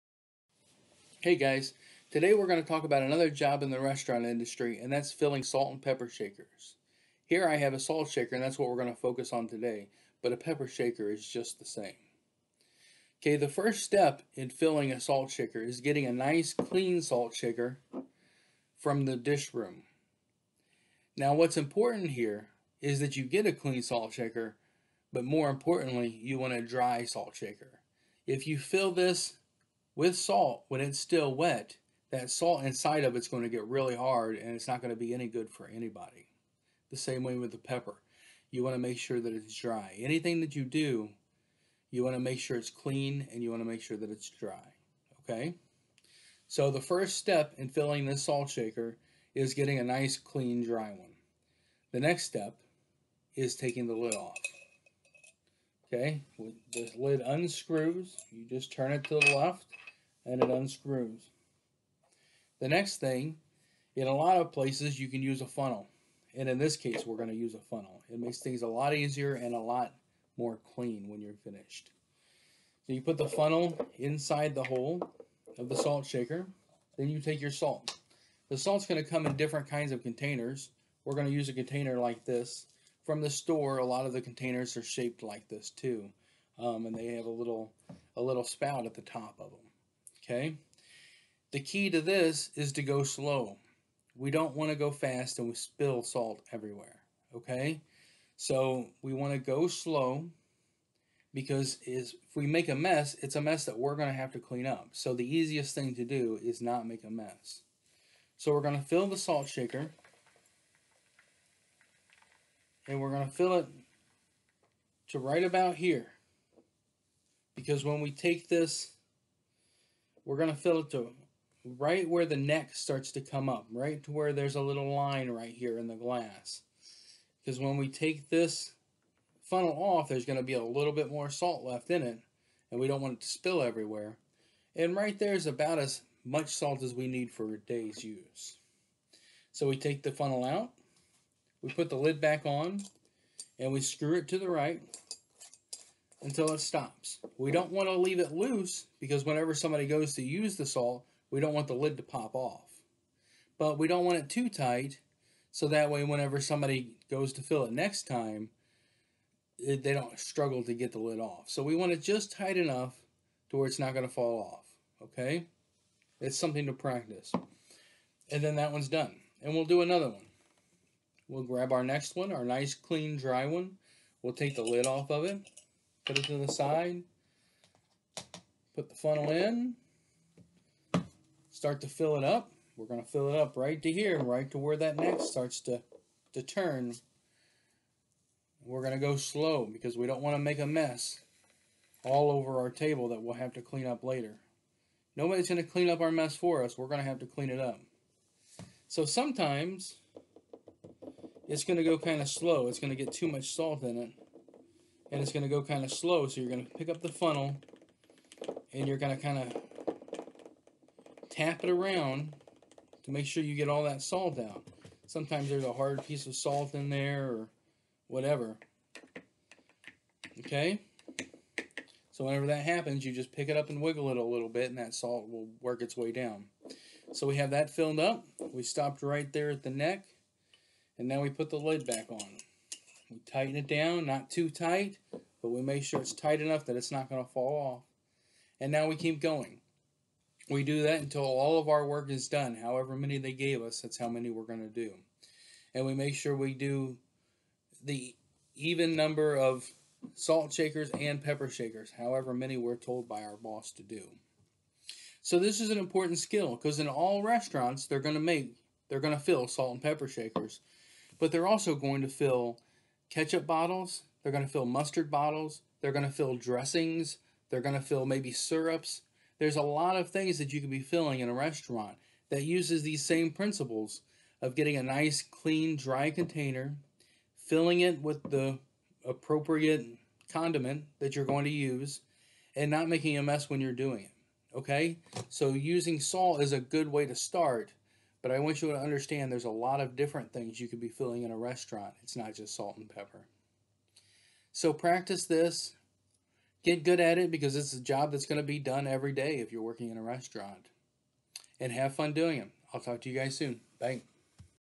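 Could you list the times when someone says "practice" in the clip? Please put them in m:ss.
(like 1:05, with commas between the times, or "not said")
2:46, 4:54.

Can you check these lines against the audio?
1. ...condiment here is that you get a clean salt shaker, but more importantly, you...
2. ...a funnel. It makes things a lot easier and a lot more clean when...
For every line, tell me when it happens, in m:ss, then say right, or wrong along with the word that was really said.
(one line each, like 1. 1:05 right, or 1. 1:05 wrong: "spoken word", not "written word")
1. 0:21 wrong: "important", not "condiment"
2. 1:07 right.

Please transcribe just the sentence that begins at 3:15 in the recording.
Nobody's going to clean up our mess for us.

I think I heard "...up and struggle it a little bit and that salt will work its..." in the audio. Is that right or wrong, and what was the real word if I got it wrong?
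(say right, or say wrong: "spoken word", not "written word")
wrong: "wiggle", not "struggle".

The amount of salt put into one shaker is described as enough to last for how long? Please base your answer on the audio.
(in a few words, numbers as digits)
A day.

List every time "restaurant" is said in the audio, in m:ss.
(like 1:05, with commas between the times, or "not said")
0:03, 4:17, 4:31, 4:51, 5:00.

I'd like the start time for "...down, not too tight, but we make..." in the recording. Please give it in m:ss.
3:53.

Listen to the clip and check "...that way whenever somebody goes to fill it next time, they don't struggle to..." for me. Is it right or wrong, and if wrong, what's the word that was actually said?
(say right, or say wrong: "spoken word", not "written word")
right.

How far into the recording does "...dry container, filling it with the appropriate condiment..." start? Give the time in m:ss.
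4:35.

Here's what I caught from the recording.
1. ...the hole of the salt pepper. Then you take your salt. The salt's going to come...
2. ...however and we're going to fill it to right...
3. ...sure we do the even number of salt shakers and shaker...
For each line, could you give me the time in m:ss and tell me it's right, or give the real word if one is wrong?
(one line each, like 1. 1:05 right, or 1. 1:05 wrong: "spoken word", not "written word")
1. 1:14 wrong: "shaker", not "pepper"
2. 1:49 wrong: "shaker", not "however"
3. 4:06 wrong: "pepper", not "shaker".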